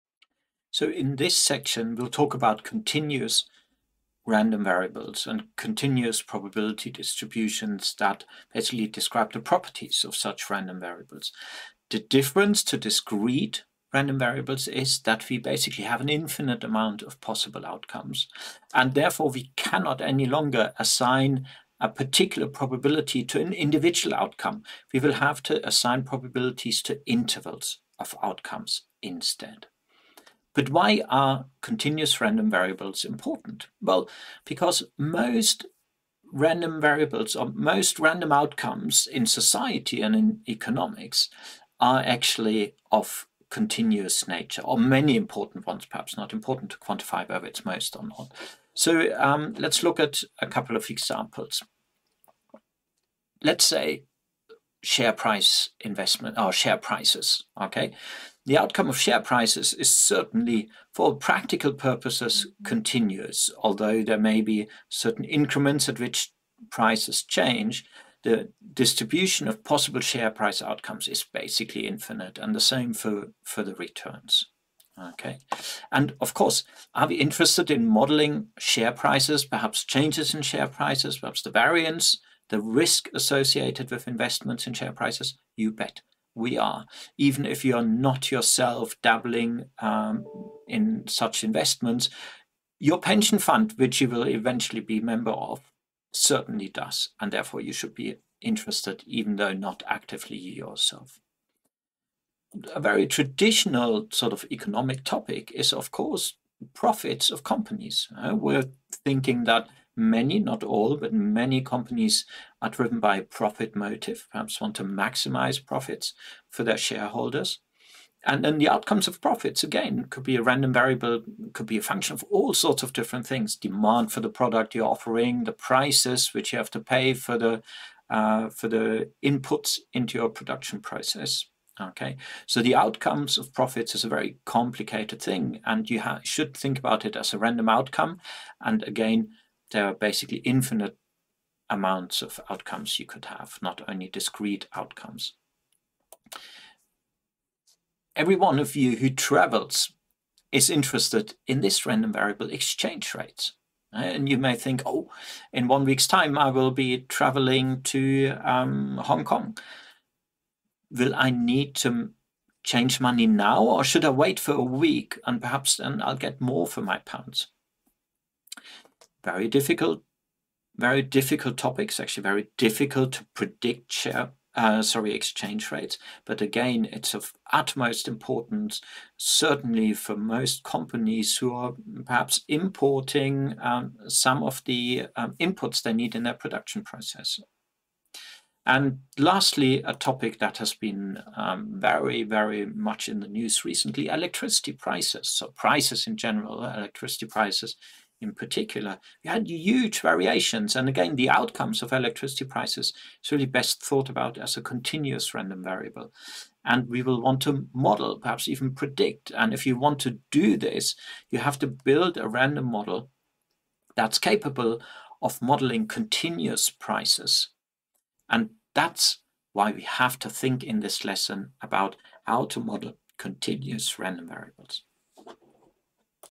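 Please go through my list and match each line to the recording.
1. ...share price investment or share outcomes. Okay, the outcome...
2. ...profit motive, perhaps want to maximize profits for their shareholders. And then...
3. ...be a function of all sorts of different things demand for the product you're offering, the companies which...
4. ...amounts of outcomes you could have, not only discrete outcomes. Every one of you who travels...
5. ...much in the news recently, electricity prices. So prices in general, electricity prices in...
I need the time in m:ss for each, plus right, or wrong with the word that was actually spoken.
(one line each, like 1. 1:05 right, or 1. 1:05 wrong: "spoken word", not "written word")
1. 0:54 wrong: "prices", not "outcomes"
2. 1:53 right
3. 2:01 wrong: "prices", not "companies"
4. 2:21 right
5. 3:12 right.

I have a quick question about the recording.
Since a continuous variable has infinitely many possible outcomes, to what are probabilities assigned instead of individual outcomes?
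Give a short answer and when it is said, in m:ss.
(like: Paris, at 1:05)
Intervals of outcomes, at 0:27.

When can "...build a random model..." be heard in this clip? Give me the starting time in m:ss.
3:31.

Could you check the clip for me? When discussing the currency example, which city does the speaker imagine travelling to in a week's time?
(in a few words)
Hong Kong.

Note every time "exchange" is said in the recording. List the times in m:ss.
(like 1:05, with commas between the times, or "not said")
2:32, 2:55.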